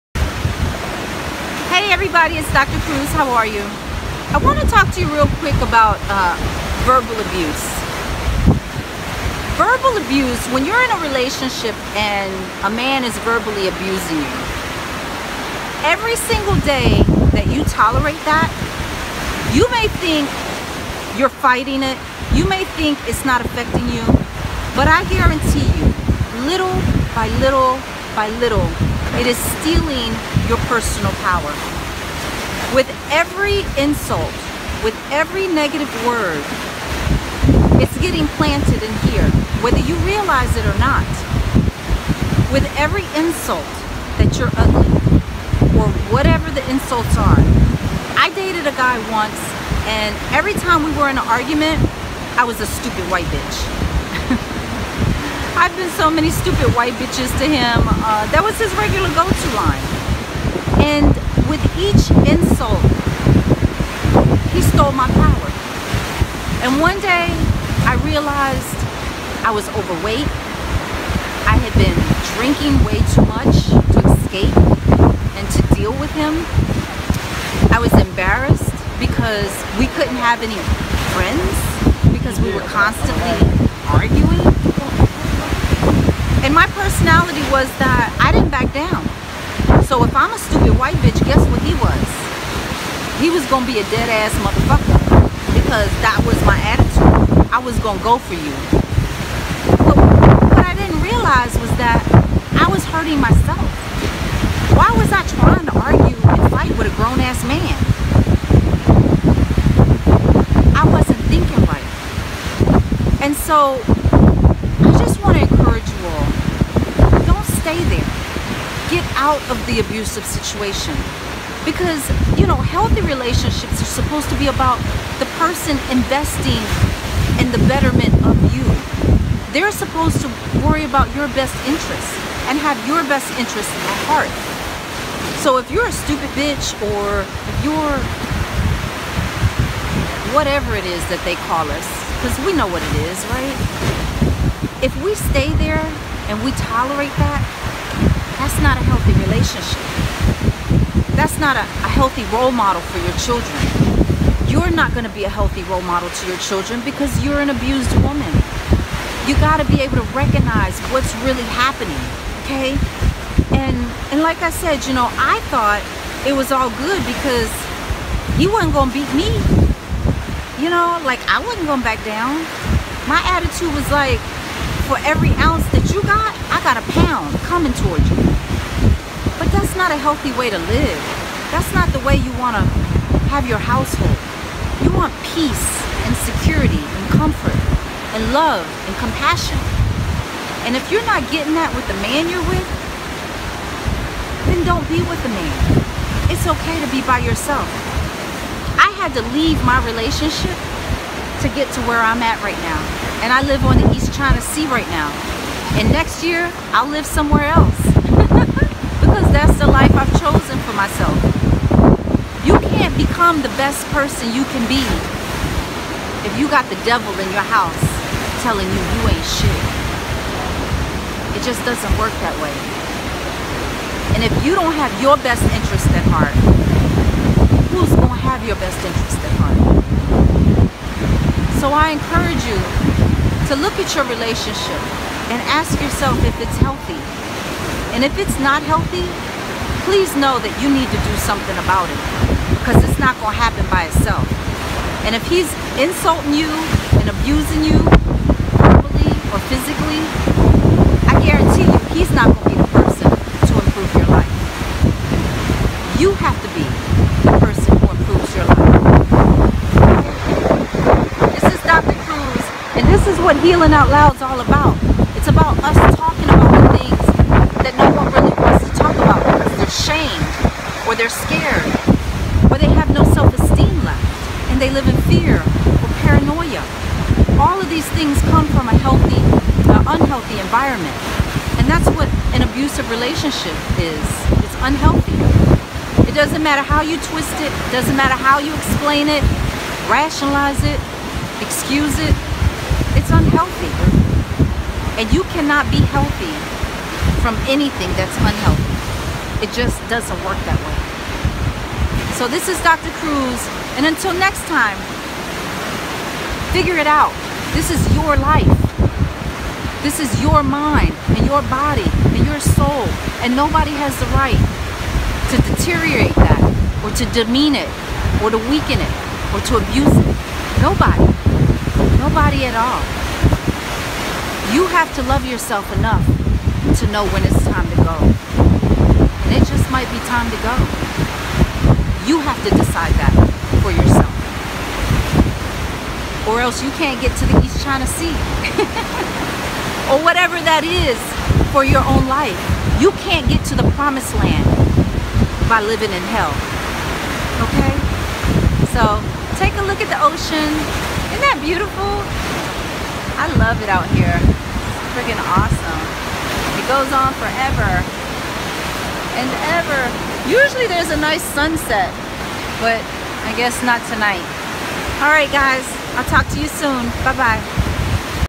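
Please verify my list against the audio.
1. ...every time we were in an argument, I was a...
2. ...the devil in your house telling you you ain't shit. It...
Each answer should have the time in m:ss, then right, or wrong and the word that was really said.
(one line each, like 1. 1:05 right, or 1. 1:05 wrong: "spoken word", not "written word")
1. 0:50 right
2. 3:36 right.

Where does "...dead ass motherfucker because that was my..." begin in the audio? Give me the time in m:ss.
1:33.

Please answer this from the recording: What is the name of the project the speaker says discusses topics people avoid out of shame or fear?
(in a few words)
Healing Out Loud.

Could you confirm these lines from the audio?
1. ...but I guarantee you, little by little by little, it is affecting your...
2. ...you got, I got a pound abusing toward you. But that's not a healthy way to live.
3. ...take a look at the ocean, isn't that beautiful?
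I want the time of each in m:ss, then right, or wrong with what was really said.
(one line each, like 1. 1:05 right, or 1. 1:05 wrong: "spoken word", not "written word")
1. 0:24 wrong: "stealing", not "affecting"
2. 2:55 wrong: "coming", not "abusing"
3. 5:49 right.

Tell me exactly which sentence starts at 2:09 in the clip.
They're supposed to worry about your best interests and have your best interests at heart.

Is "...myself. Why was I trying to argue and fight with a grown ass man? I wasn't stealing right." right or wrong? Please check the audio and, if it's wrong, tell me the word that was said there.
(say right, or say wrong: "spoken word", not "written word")
wrong: "thinking", not "stealing".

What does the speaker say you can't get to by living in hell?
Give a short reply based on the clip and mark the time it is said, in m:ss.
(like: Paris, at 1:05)
the promised land, at 5:43.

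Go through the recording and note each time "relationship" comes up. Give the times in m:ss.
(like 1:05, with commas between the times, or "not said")
0:11, 2:03, 2:29, 3:19, 3:54, 4:42.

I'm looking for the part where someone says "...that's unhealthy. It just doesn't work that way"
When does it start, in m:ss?
4:57.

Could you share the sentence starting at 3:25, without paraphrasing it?
And next year, I'll live somewhere else.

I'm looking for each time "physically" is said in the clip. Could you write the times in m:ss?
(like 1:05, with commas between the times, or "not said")
4:09.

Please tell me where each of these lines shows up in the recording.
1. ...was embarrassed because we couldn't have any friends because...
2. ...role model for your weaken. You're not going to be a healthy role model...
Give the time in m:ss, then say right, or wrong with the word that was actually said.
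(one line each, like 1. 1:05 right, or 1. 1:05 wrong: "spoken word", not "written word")
1. 1:17 right
2. 2:32 wrong: "children", not "weaken".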